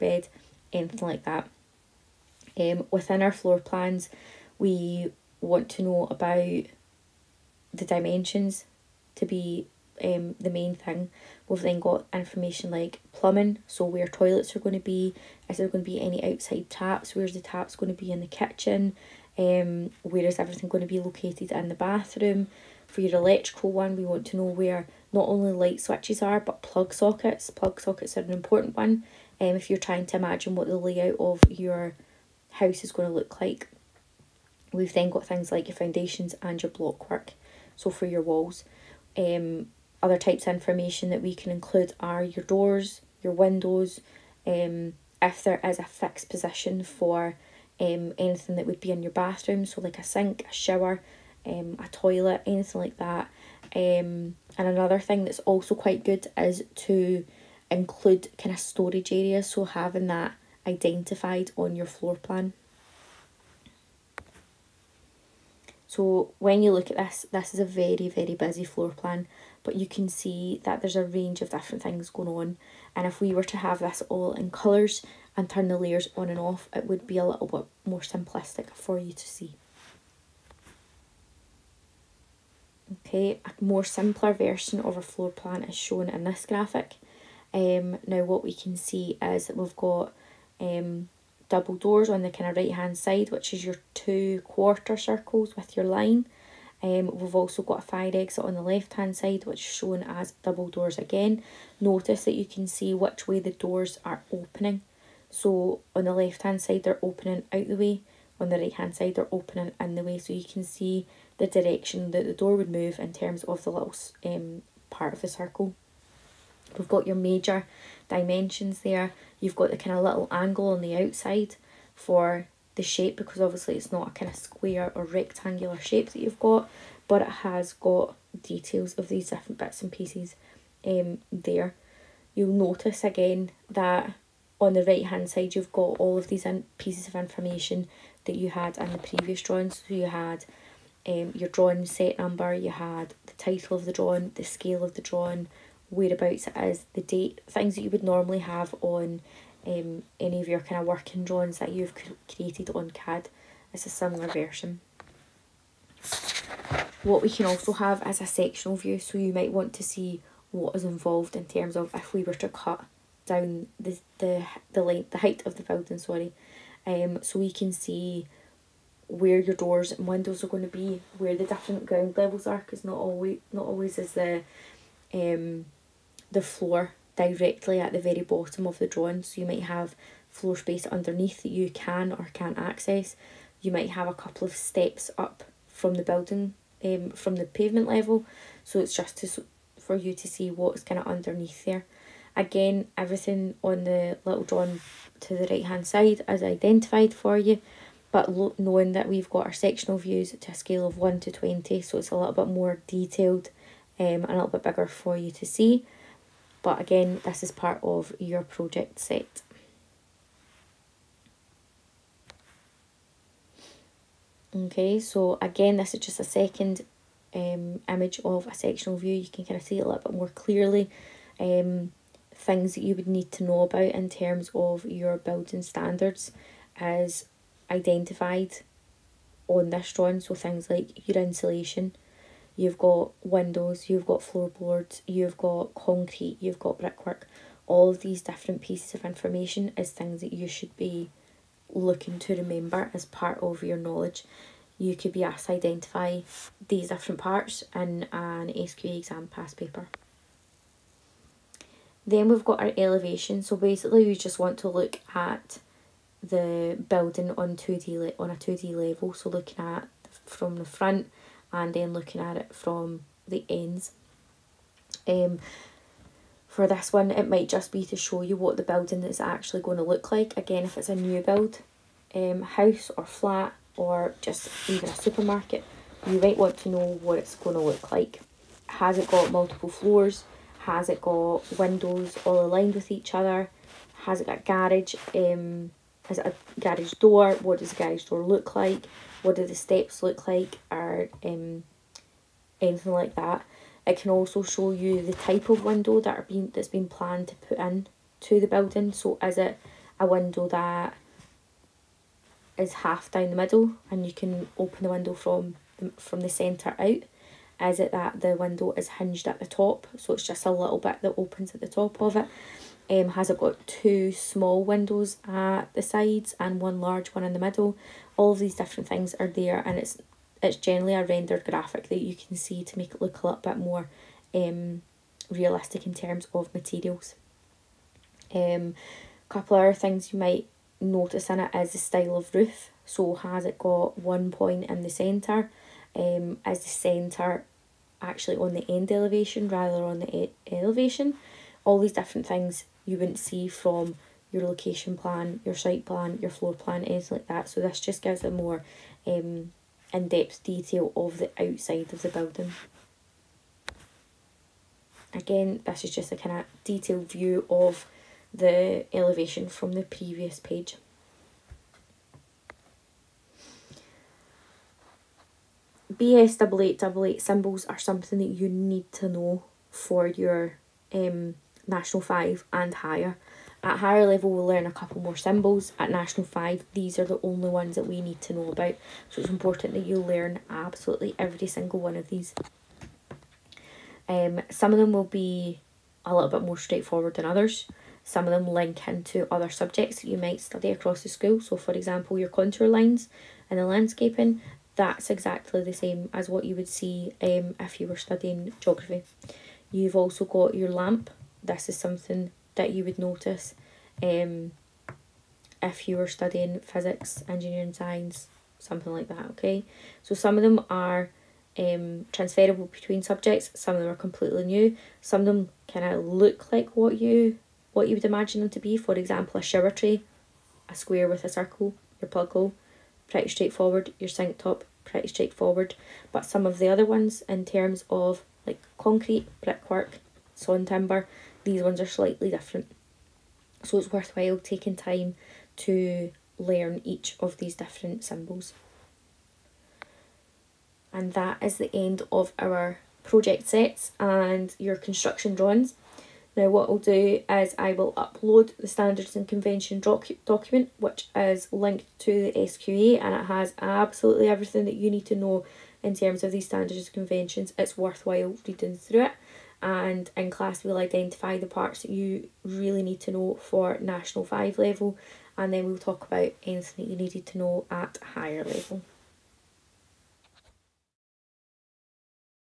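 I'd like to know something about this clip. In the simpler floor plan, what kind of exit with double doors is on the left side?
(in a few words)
Fire exit.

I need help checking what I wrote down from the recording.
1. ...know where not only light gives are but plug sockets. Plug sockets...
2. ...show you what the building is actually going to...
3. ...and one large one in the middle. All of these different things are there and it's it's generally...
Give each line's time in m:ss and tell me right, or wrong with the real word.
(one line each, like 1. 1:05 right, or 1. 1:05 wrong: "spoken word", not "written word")
1. 0:24 wrong: "switches", not "gives"
2. 4:27 right
3. 5:16 right.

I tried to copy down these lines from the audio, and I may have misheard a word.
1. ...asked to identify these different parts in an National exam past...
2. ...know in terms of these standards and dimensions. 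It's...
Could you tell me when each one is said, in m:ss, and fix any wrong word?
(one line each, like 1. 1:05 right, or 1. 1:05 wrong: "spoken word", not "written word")
1. 4:05 wrong: "SQA", not "National"
2. 7:35 wrong: "conventions", not "dimensions".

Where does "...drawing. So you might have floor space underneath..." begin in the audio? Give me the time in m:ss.
2:58.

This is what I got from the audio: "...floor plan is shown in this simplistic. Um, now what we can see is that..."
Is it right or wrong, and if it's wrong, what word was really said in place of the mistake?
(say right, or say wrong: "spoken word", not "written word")
wrong: "graphic", not "simplistic".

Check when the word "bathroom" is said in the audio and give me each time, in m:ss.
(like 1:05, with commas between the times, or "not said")
0:21, 0:49.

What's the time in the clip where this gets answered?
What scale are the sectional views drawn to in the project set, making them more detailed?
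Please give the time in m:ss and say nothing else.
3:20.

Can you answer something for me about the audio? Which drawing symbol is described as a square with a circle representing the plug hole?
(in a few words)
Shower tray.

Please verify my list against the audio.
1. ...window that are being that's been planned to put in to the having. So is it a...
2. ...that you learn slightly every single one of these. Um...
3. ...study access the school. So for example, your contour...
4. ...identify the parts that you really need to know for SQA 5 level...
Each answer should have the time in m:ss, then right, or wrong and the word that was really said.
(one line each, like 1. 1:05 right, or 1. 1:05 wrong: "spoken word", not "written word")
1. 4:55 wrong: "building", not "having"
2. 6:19 wrong: "absolutely", not "slightly"
3. 6:30 wrong: "across", not "access"
4. 7:40 wrong: "National", not "SQA".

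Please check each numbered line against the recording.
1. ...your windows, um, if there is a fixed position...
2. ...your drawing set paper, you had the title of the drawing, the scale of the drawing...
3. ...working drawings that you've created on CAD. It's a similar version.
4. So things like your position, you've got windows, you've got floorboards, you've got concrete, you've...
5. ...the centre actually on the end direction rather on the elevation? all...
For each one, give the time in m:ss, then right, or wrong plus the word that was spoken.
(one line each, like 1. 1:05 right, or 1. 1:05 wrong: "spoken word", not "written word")
1. 0:43 right
2. 2:21 wrong: "number", not "paper"
3. 2:30 right
4. 3:50 wrong: "insulation", not "position"
5. 5:36 wrong: "elevation", not "direction".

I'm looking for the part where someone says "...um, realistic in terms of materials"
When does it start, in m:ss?
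5:24.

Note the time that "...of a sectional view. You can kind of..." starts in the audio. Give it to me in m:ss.
3:38.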